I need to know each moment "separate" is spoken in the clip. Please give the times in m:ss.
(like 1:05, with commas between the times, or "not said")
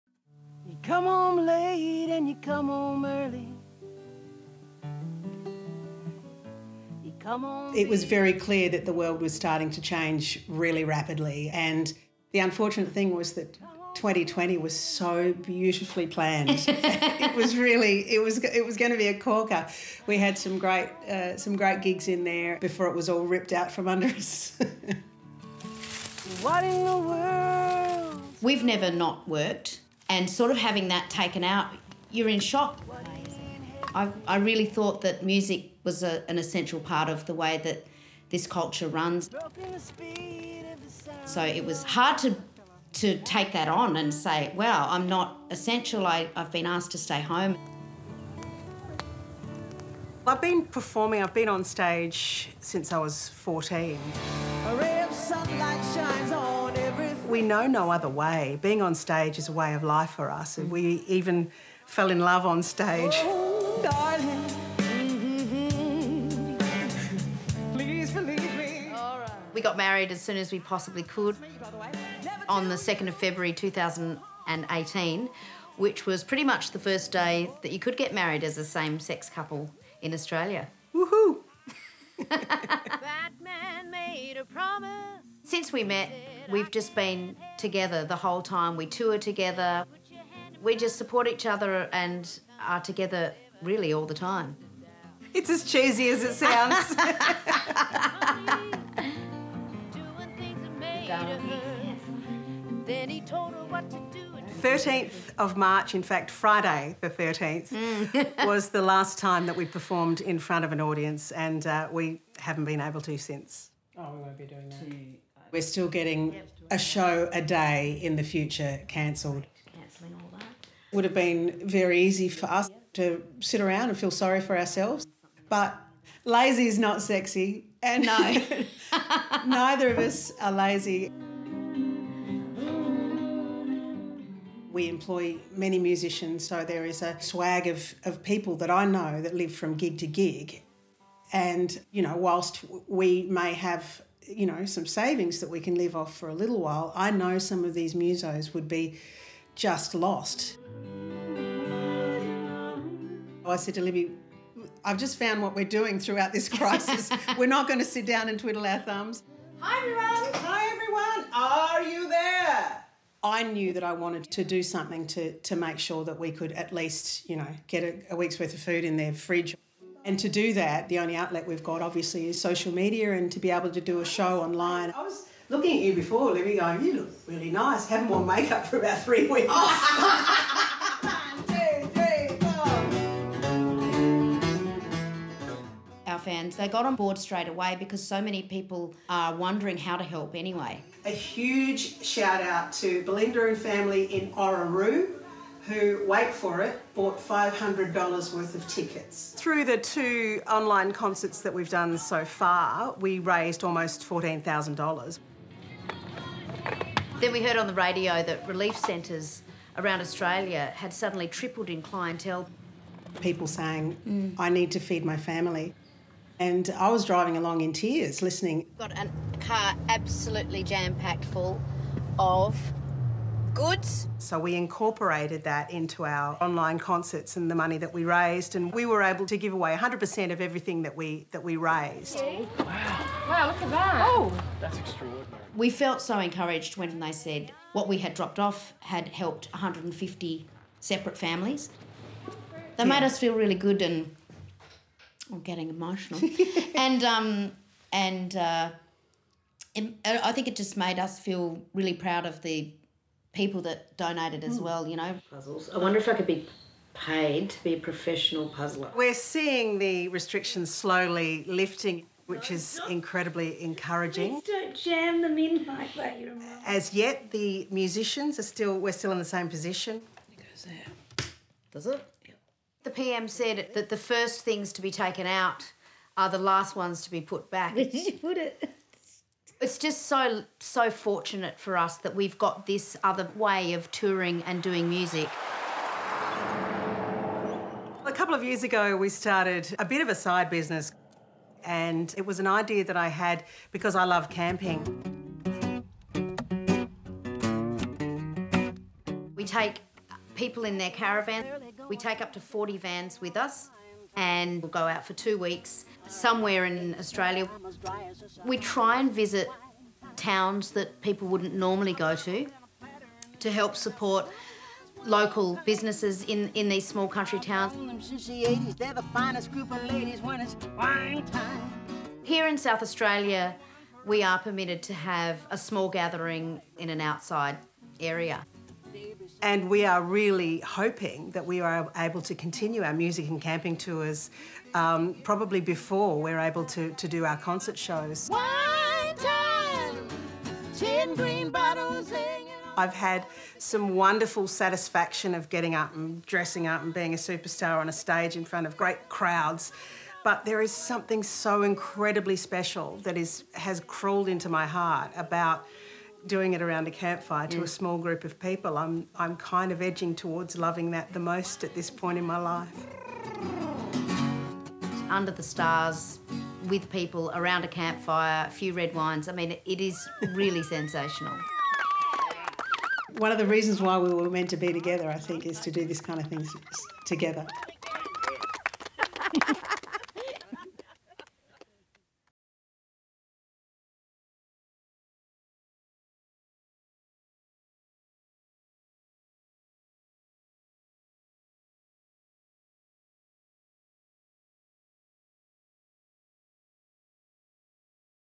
4:00.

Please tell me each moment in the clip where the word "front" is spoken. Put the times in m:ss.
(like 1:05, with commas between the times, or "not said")
1:50, 5:48.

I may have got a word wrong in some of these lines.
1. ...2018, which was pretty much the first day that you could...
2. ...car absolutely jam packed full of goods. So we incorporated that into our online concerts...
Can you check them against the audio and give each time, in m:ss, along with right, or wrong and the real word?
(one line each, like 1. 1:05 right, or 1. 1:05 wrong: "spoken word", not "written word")
1. 1:13 right
2. 3:39 right.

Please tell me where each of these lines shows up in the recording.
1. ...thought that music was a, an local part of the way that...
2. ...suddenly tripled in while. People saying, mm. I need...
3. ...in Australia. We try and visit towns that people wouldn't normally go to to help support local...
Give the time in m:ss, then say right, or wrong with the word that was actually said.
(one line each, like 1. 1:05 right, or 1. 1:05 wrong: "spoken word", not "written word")
1. 0:34 wrong: "essential", not "local"
2. 3:30 wrong: "clientele", not "while"
3. 5:06 right.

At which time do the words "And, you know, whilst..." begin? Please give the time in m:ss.
2:21.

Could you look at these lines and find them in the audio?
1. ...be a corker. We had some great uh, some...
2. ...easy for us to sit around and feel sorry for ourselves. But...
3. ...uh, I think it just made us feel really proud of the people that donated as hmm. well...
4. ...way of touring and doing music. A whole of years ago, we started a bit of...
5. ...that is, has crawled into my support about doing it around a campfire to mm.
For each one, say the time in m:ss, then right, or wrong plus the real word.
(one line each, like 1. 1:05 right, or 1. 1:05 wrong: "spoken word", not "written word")
1. 0:18 right
2. 2:01 right
3. 4:08 right
4. 4:43 wrong: "couple", not "whole"
5. 5:53 wrong: "heart", not "support".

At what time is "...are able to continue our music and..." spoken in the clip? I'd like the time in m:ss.
5:31.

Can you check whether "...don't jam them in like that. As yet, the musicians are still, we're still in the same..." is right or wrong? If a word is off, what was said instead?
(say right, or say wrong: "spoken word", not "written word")
right.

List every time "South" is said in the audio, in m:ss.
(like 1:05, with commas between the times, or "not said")
5:22.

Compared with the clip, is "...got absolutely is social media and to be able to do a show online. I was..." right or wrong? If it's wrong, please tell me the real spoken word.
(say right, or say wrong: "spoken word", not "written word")
wrong: "obviously", not "absolutely".